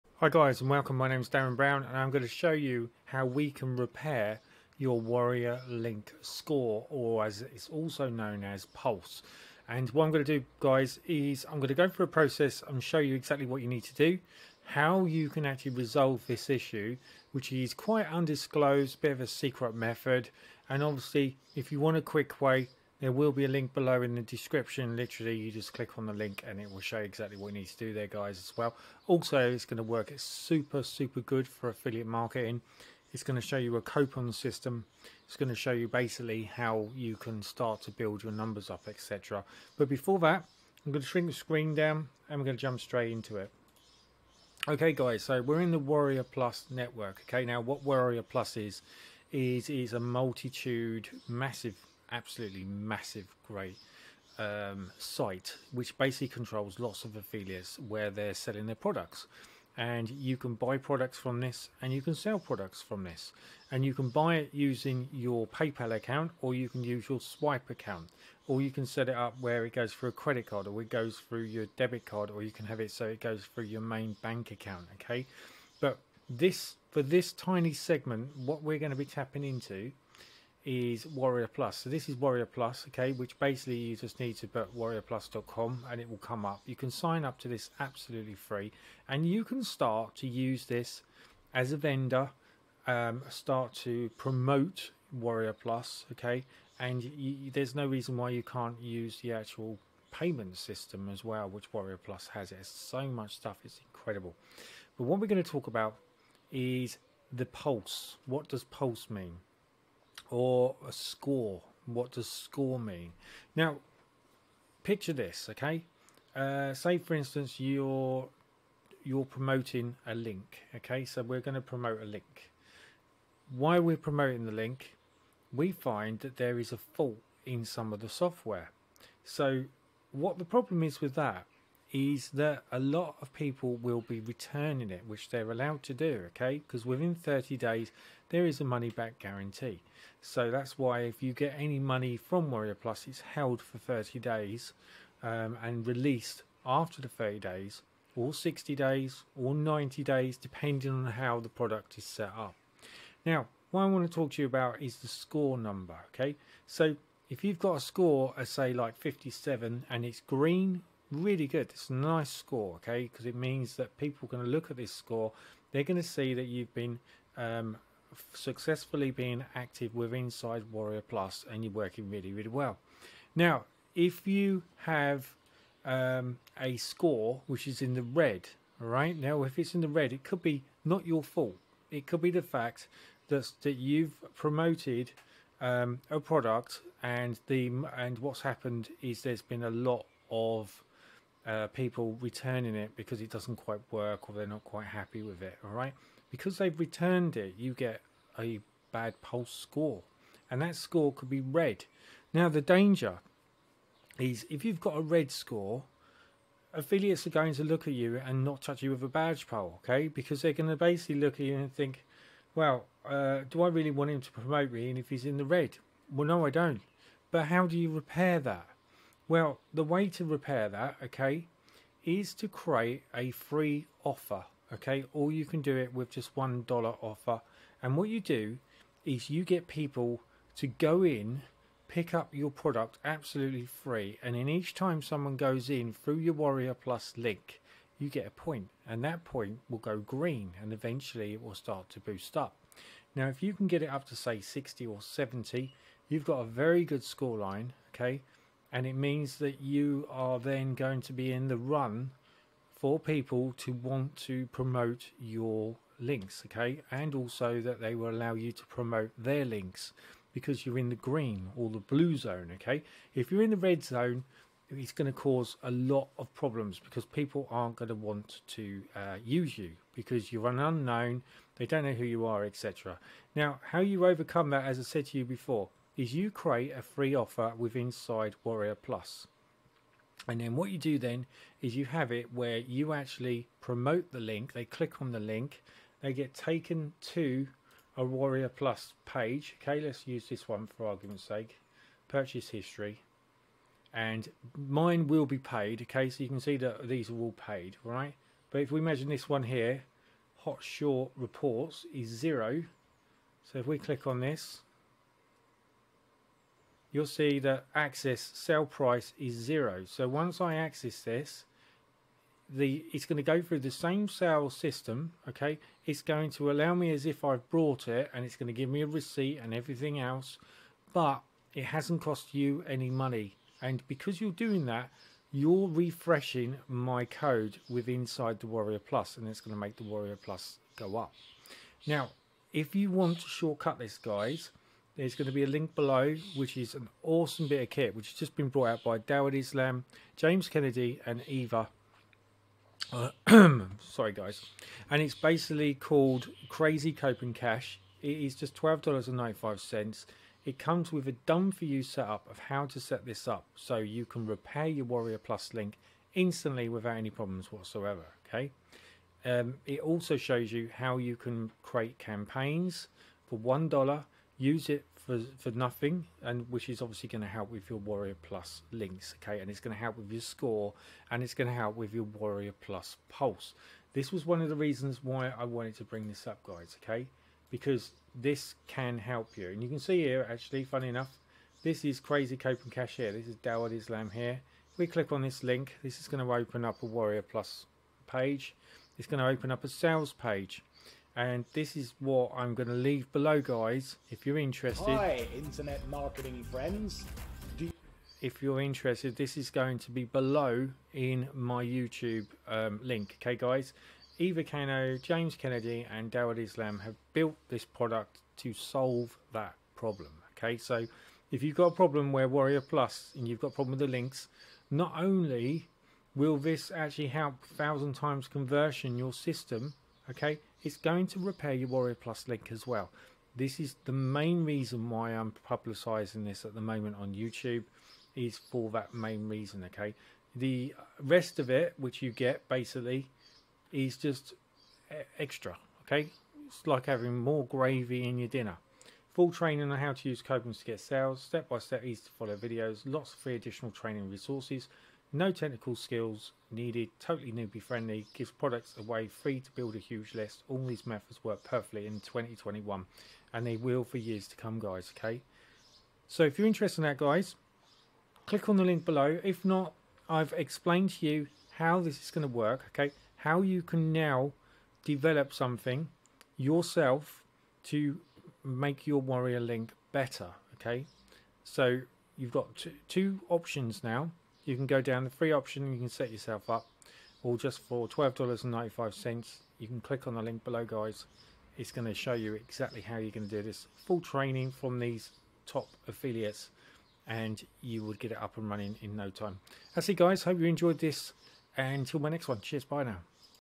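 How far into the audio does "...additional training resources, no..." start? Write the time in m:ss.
7:23.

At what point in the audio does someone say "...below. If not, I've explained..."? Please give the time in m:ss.
7:38.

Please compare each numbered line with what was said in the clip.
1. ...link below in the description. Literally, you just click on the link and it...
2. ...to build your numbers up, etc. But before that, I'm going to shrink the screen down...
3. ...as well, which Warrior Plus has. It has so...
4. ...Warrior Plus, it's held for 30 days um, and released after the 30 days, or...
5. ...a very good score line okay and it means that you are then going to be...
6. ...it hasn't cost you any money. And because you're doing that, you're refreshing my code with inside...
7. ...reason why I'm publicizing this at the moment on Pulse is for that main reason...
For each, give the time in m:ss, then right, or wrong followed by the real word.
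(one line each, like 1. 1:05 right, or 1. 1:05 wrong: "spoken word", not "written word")
1. 0:23 right
2. 0:37 right
3. 1:41 right
4. 2:22 right
5. 4:06 right
6. 5:21 right
7. 7:04 wrong: "YouTube", not "Pulse".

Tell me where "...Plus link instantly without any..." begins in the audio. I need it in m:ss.
5:55.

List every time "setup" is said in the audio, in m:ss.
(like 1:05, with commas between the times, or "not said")
5:51.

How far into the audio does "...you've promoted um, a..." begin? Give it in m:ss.
3:03.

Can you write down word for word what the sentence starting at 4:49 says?
Okay, let's use this one for argument's sake.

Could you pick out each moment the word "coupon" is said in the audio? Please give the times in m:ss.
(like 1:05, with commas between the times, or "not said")
0:33, 6:22, 7:20.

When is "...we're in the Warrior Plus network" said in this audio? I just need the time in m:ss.
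0:45.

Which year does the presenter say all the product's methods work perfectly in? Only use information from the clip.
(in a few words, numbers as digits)
2021.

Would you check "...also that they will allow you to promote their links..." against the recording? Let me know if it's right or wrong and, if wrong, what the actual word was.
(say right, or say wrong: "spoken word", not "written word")
right.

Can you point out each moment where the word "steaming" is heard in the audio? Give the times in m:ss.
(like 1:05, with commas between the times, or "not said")
not said.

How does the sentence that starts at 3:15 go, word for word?
All right because they've returned it, you get a bad pulse score, and that score could be red.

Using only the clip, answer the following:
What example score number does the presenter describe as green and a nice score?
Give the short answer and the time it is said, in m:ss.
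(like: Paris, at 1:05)
57, at 2:38.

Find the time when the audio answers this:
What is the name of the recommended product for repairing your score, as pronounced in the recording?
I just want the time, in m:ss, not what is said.
5:46.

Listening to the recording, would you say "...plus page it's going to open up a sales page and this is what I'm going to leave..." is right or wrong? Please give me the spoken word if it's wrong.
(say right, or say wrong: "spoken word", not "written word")
right.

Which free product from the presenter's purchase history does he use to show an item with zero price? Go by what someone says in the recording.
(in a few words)
Hot Short Reports.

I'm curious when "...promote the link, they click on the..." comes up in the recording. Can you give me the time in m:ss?
4:43.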